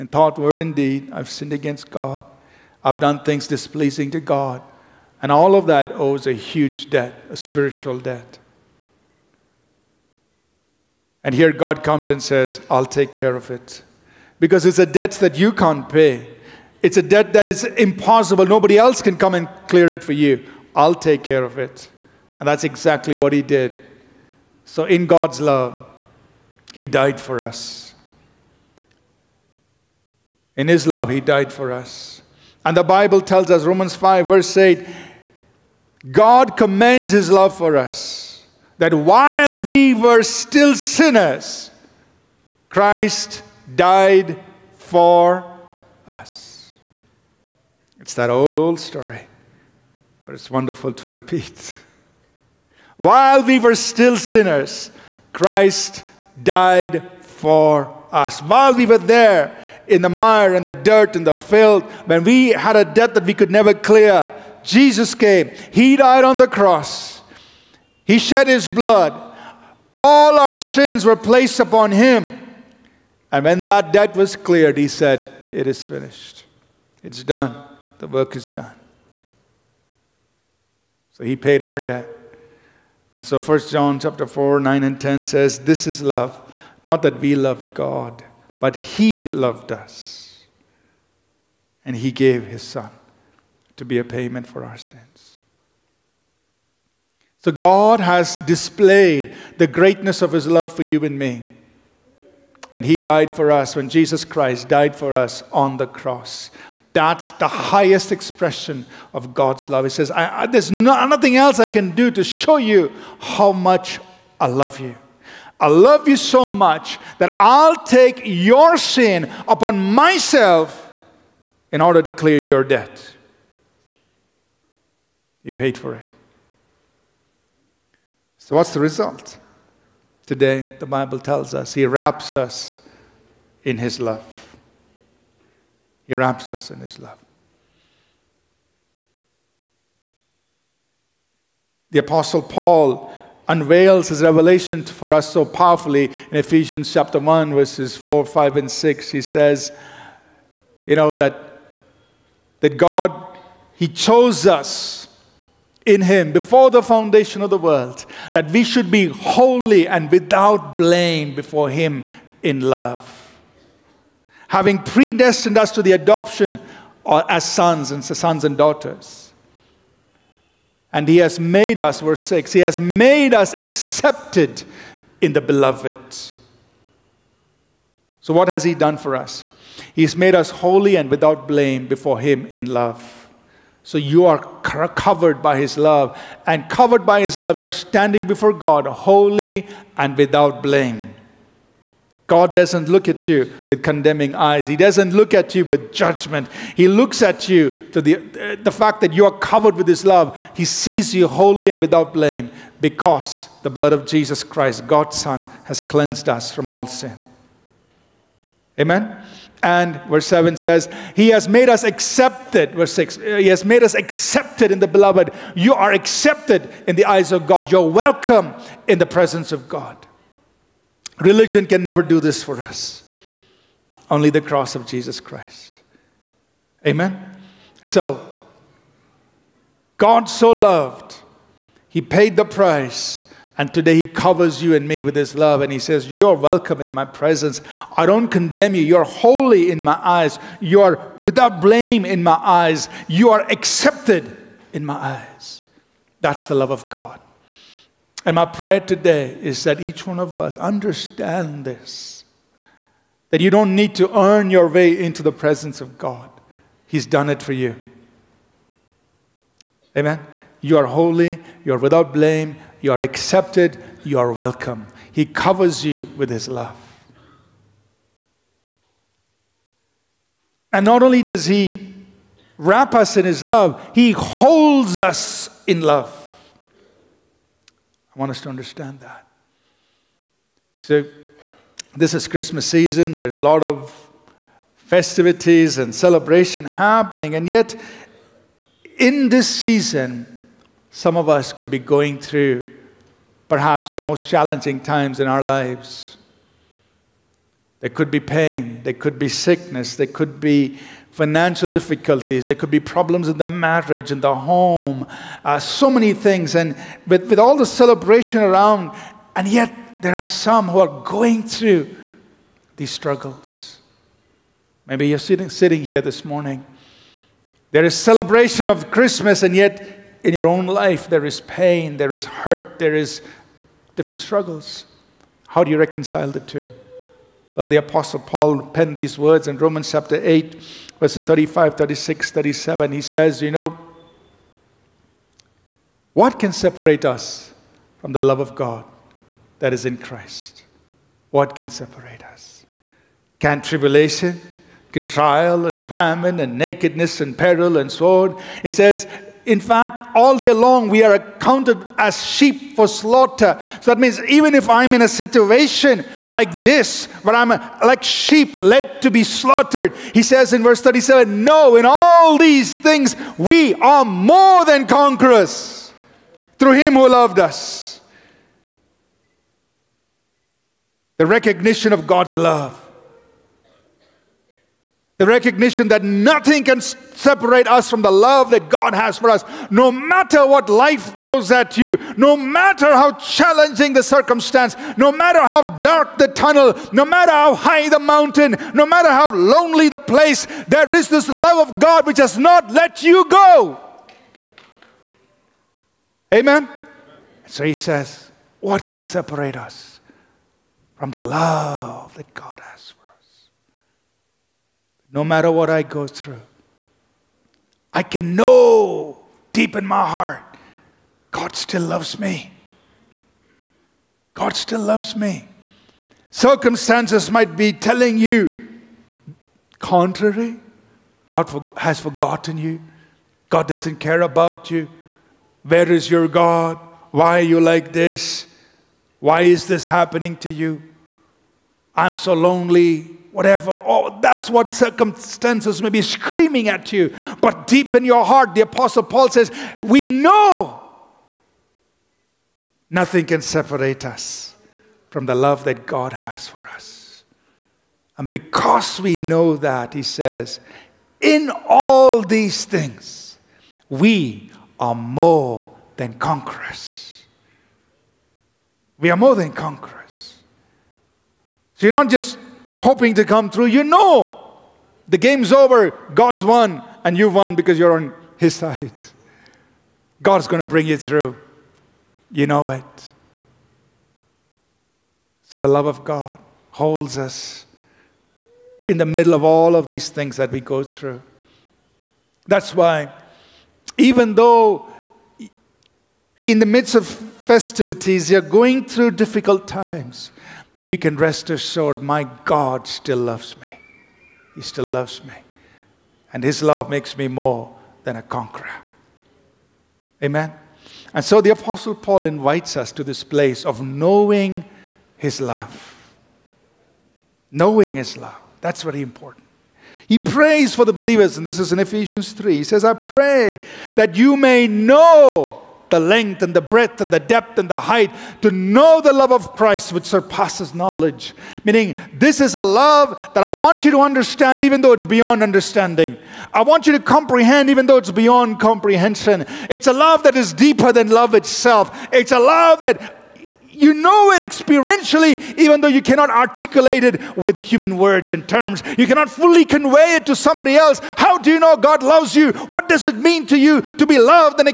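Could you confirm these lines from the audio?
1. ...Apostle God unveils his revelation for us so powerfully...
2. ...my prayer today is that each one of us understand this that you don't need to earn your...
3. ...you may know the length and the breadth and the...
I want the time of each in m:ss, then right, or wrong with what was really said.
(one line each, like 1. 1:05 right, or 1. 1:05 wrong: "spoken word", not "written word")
1. 2:21 wrong: "Paul", not "God"
2. 4:08 right
3. 8:34 right.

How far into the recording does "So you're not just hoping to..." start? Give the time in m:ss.
7:41.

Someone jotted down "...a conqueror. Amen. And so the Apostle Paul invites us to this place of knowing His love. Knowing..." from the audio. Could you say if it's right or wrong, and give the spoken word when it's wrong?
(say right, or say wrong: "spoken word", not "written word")
right.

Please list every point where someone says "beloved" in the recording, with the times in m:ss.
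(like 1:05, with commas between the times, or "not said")
2:55, 3:34.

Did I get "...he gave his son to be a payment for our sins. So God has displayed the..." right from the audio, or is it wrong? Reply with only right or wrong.
right.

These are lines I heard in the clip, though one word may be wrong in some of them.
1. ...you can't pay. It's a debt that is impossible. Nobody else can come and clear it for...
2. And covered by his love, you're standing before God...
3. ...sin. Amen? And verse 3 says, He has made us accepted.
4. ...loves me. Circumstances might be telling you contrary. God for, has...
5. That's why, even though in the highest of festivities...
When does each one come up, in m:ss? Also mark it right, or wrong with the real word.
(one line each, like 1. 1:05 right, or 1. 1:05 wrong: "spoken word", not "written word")
1. 0:15 right
2. 3:06 right
3. 3:26 wrong: "7", not "3"
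4. 6:54 right
5. 8:02 wrong: "midst", not "highest".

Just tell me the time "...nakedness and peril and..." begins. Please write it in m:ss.
5:46.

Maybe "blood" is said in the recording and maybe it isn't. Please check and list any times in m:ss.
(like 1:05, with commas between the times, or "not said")
1:08, 3:23.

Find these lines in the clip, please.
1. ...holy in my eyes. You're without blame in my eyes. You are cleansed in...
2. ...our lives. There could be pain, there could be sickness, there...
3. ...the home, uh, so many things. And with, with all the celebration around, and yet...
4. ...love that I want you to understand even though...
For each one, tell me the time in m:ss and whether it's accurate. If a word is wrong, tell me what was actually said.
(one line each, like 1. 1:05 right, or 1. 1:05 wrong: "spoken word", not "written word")
1. 3:59 wrong: "accepted", not "cleansed"
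2. 4:55 right
3. 5:04 right
4. 8:42 right.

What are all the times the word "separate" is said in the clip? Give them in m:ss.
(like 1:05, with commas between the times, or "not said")
5:36, 5:41, 6:16, 6:39, 7:23.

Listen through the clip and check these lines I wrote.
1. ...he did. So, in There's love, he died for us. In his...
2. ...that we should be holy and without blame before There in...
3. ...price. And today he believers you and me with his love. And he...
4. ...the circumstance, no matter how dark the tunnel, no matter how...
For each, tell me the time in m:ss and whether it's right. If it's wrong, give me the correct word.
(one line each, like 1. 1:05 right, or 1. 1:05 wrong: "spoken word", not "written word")
1. 0:23 wrong: "God", not "There"
2. 2:38 wrong: "Him", not "There"
3. 3:52 wrong: "covers", not "believers"
4. 6:23 right.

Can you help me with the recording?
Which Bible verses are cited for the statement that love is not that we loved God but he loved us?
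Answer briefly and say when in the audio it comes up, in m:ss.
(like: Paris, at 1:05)
1 John 4:9-10, at 1:23.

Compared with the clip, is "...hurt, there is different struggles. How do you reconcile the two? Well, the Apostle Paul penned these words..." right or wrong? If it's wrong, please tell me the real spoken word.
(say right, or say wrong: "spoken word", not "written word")
right.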